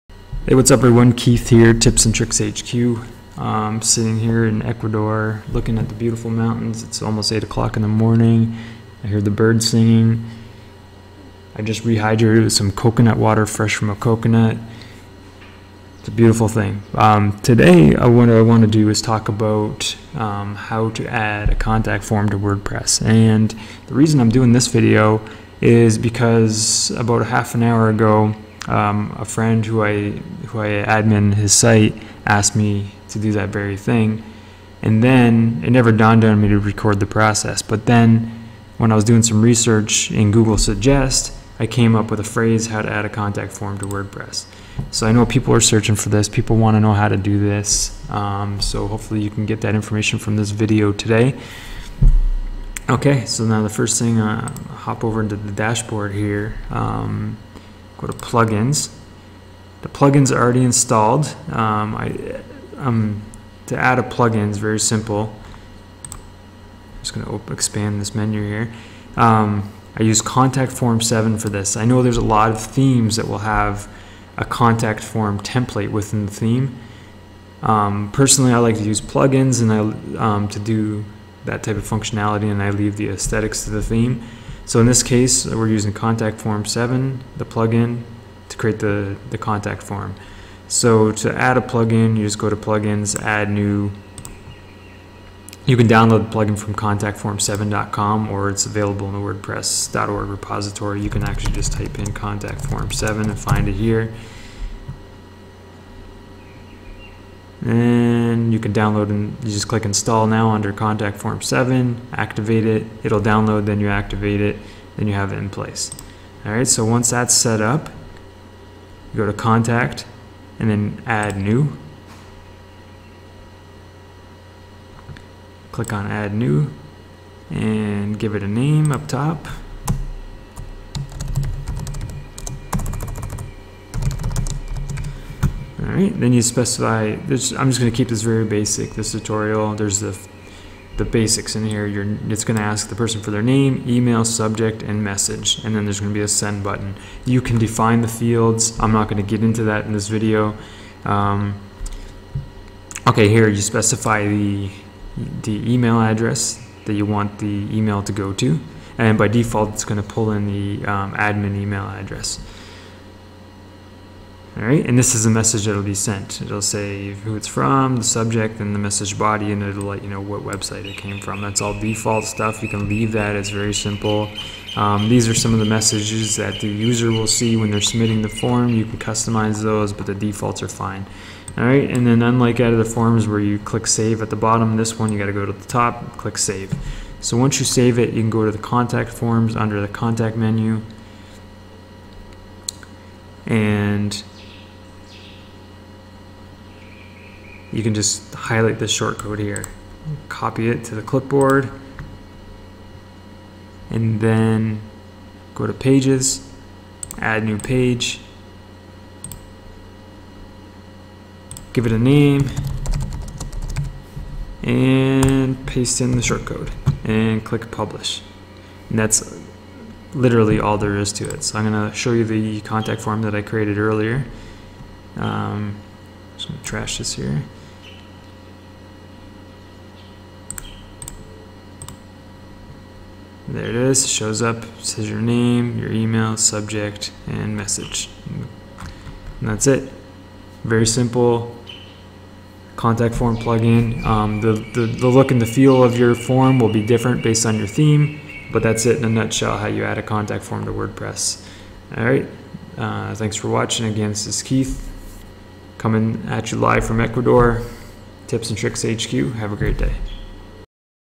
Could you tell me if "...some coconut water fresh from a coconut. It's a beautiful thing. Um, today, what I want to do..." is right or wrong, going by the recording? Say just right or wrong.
right.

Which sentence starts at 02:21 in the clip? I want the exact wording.
You're, it's gonna ask the person for their name, email, subject, and message, and then there's gonna be a send button.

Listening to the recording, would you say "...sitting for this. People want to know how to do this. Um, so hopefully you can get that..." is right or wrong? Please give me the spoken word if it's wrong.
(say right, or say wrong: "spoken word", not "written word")
wrong: "searching", not "sitting".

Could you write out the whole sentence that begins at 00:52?
Okay, so now the first thing, uh, hop over into the dashboard here.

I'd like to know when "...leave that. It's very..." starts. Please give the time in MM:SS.
02:52.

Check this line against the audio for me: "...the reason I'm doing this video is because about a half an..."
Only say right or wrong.
right.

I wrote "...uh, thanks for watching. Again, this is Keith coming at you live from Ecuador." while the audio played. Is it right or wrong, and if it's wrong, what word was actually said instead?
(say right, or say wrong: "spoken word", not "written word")
right.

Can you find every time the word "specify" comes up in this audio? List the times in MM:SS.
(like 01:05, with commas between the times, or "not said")
02:16, 02:33.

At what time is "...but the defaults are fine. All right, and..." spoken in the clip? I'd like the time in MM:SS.
02:59.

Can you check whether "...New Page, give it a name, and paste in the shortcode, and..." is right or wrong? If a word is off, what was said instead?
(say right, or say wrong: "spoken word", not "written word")
right.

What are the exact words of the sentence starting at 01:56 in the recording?
All right, so once that's set up, go to contact and then add new.